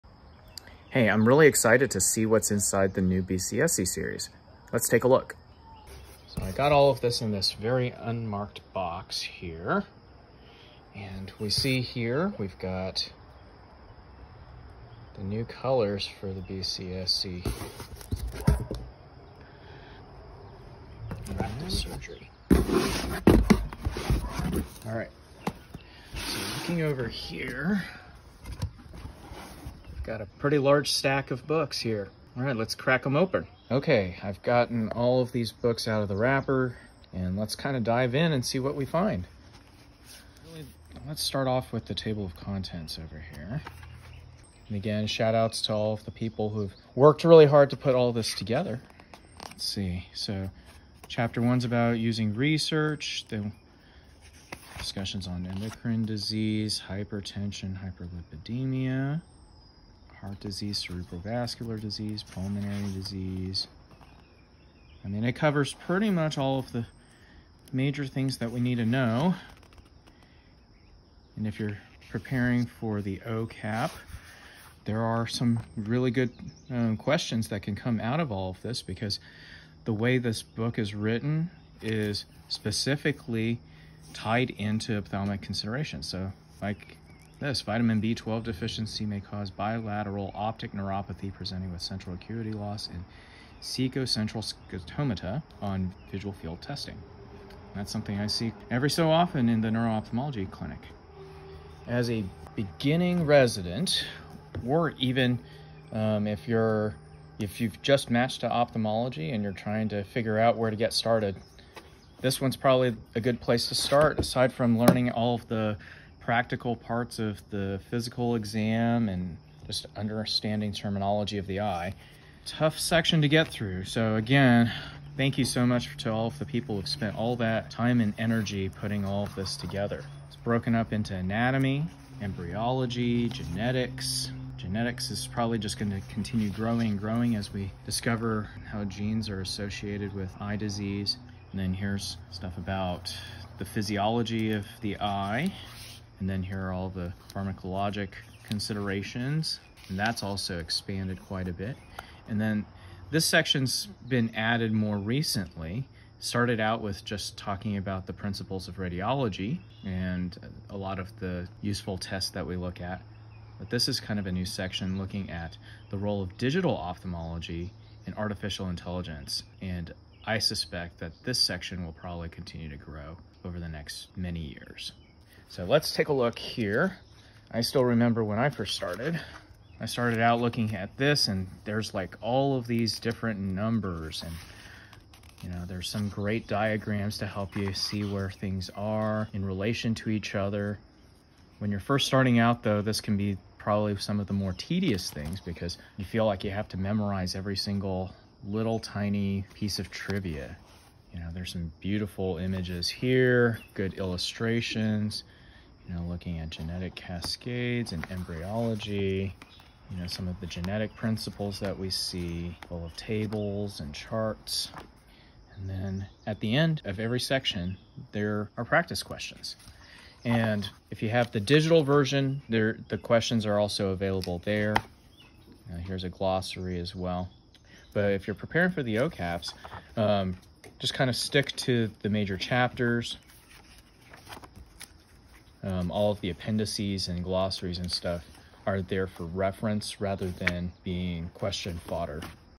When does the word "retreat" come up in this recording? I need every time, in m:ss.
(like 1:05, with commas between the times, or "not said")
not said.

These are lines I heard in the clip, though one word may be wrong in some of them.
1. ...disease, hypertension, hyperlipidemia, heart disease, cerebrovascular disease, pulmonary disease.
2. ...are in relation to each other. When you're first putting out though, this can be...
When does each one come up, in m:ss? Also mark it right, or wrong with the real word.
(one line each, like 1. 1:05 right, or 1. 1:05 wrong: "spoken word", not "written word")
1. 0:56 right
2. 3:08 wrong: "starting", not "putting".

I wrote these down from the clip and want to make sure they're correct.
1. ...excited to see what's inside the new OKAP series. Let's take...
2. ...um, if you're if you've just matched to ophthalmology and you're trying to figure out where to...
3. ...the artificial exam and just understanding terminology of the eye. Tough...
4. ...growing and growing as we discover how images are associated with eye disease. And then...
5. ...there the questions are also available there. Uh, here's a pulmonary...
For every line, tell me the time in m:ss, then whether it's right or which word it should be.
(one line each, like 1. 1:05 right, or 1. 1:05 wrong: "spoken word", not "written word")
1. 0:01 wrong: "BCSC", not "OKAP"
2. 1:45 right
3. 1:57 wrong: "physical", not "artificial"
4. 2:16 wrong: "genes", not "images"
5. 3:42 wrong: "glossary", not "pulmonary".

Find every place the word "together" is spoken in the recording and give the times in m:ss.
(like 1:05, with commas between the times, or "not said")
0:48, 2:09.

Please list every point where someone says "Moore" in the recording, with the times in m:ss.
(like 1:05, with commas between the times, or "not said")
not said.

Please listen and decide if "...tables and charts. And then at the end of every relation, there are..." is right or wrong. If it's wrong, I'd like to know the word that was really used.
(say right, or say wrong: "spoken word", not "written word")
wrong: "section", not "relation".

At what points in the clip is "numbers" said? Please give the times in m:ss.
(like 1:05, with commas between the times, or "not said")
3:03.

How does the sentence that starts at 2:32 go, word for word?
And then this section's been added more recently.